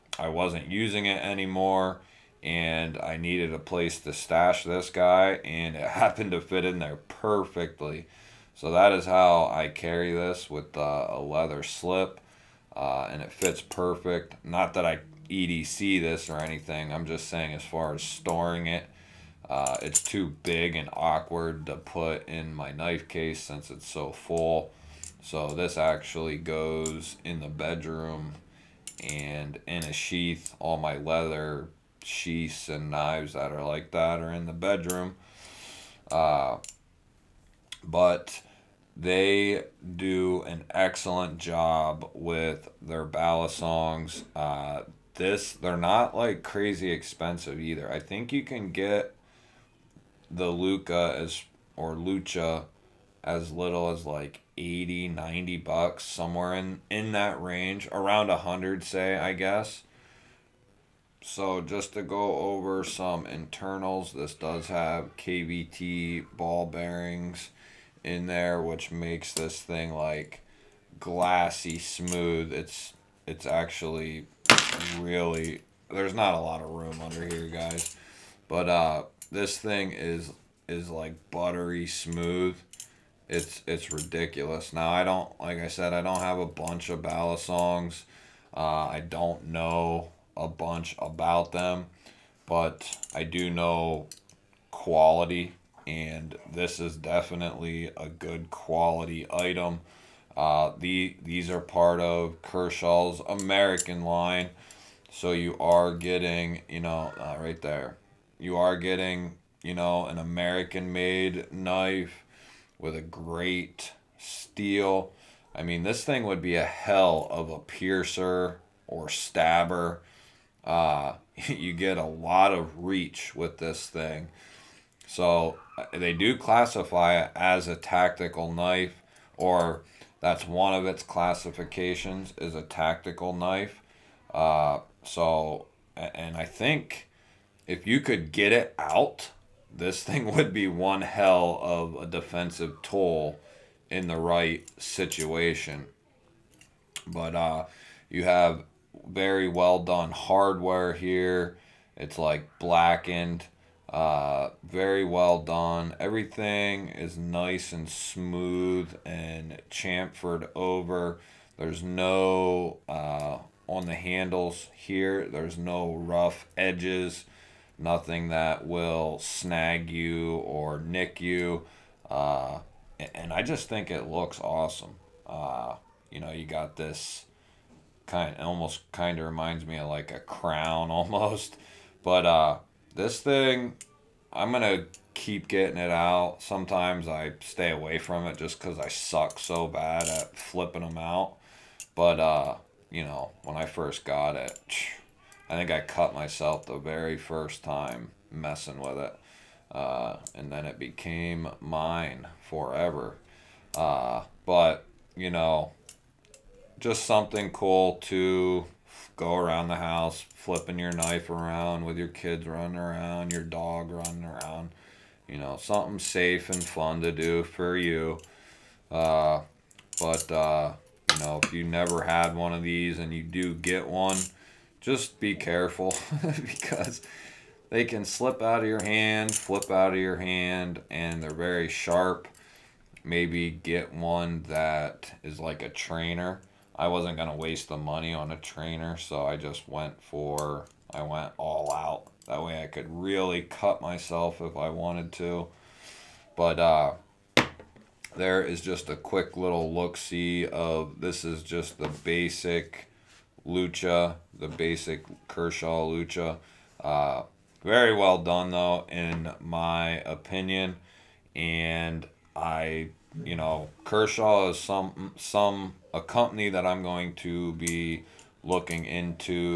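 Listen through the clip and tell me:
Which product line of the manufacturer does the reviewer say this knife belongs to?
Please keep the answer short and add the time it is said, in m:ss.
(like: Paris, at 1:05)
American line, at 1:43.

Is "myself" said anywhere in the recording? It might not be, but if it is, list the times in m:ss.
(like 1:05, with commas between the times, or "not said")
3:16, 4:03.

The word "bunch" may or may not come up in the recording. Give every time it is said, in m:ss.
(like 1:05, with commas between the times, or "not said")
1:26, 1:30.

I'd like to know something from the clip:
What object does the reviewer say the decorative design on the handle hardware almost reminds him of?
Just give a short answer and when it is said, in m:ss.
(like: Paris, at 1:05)
A crown, at 3:00.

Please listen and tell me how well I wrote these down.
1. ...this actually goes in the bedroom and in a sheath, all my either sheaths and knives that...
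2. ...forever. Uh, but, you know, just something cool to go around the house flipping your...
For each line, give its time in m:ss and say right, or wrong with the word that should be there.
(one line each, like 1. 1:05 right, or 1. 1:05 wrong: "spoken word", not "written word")
1. 0:25 wrong: "leather", not "either"
2. 3:22 right.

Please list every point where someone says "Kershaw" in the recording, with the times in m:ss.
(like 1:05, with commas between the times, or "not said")
1:42, 4:15, 4:23.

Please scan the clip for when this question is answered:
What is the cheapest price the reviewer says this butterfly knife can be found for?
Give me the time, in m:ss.
0:54.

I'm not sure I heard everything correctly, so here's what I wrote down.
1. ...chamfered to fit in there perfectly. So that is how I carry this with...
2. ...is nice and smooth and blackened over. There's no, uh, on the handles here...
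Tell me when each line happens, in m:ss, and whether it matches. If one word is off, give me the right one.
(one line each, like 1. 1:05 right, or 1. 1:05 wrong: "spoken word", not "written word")
1. 0:05 wrong: "happened", not "chamfered"
2. 2:36 wrong: "chamfered", not "blackened".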